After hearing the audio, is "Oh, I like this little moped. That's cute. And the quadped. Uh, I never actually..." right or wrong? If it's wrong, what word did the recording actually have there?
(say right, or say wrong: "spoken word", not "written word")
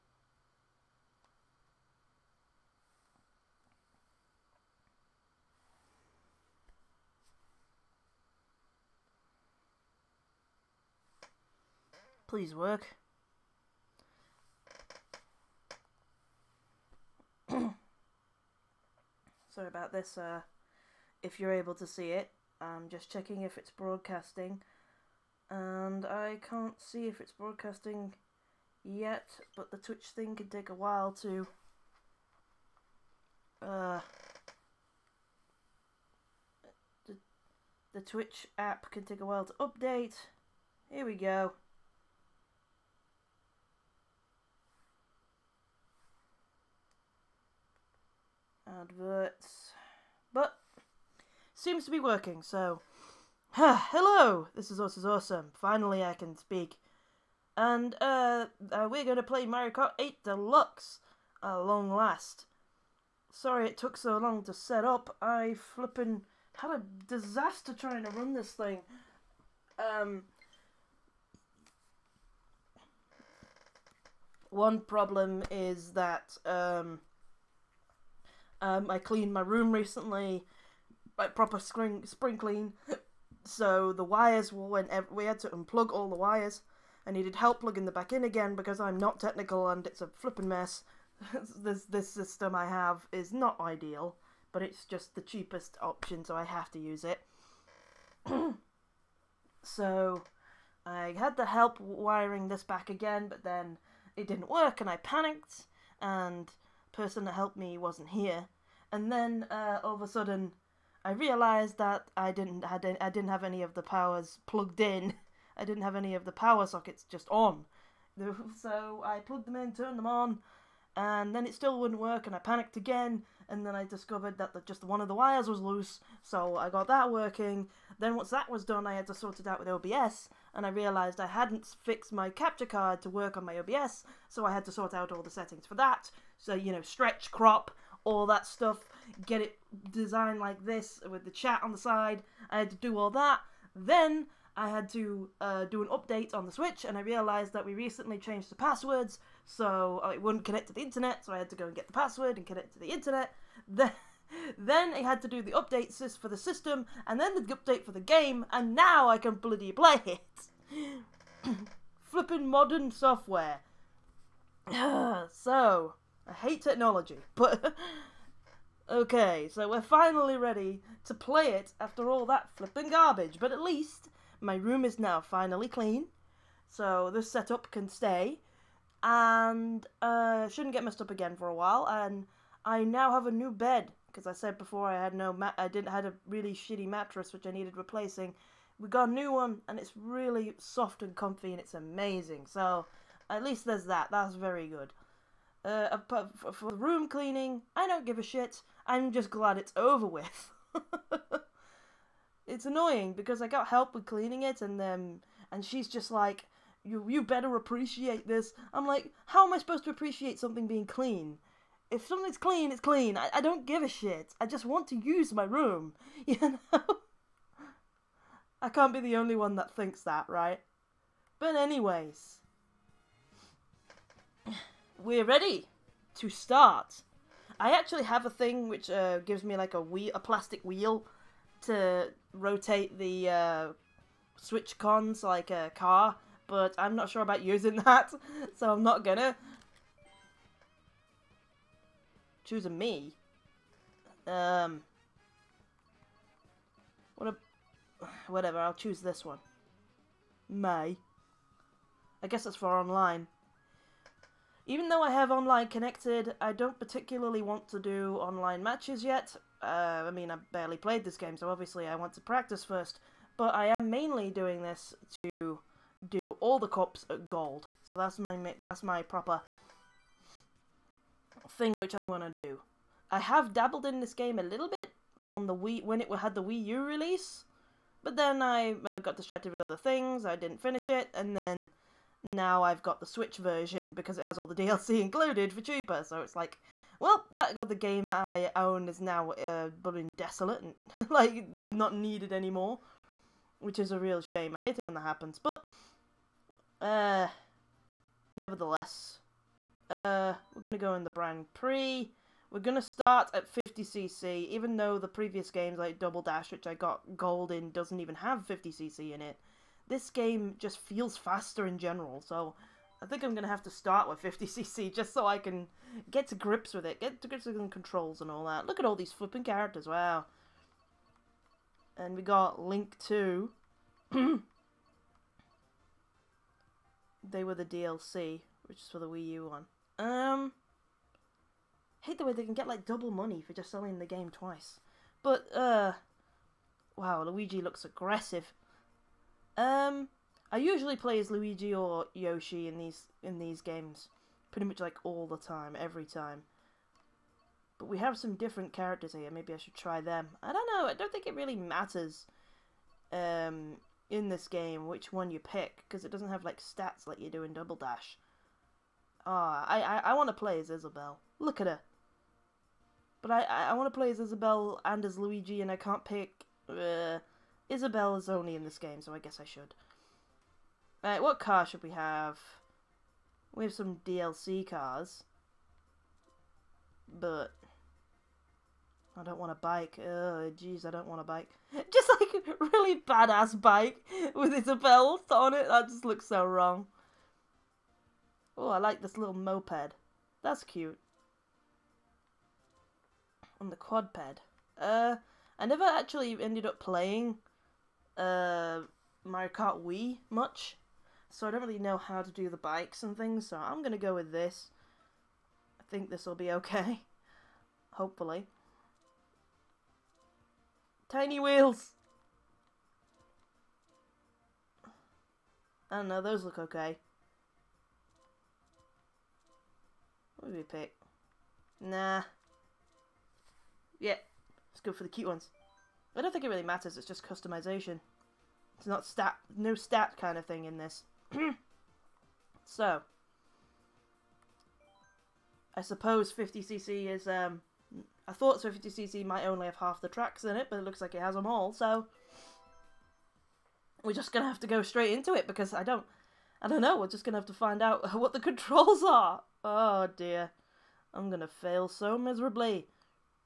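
right.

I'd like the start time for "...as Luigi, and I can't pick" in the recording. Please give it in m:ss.
6:05.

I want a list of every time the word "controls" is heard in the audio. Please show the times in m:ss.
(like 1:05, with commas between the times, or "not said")
5:17, 7:28.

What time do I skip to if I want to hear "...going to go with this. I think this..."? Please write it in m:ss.
6:43.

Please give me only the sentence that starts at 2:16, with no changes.
So you know, stretch, crop, all that stuff, get it designed like this with the chat on the side.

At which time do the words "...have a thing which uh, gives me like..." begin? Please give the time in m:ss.
3:48.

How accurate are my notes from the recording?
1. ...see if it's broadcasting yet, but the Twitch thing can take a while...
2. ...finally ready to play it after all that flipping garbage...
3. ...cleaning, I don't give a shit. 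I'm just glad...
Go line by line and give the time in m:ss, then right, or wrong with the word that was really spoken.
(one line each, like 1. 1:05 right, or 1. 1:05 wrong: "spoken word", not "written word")
1. 0:26 right
2. 2:49 right
3. 3:17 right.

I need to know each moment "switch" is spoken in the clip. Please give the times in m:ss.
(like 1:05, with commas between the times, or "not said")
2:26, 3:54, 4:43.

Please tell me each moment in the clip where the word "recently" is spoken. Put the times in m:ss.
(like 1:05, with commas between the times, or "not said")
1:19, 2:27.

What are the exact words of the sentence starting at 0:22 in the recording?
I'm just checking if it's broadcasting.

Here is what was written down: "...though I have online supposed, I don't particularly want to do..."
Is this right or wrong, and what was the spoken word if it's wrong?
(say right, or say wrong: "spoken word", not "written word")
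wrong: "connected", not "supposed".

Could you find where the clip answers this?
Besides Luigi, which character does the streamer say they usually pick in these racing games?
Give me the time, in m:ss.
5:42.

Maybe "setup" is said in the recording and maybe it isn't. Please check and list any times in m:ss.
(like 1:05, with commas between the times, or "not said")
2:57.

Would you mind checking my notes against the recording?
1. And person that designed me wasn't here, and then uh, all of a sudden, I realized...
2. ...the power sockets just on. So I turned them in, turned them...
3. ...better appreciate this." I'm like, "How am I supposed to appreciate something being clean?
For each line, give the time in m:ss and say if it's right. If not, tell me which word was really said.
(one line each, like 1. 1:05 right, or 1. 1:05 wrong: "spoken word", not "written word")
1. 1:46 wrong: "helped", not "designed"
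2. 1:56 wrong: "plugged", not "turned"
3. 3:27 right.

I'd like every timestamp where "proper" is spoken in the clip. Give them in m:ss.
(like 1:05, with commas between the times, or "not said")
1:21, 4:29.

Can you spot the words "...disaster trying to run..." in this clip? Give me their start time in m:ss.
1:07.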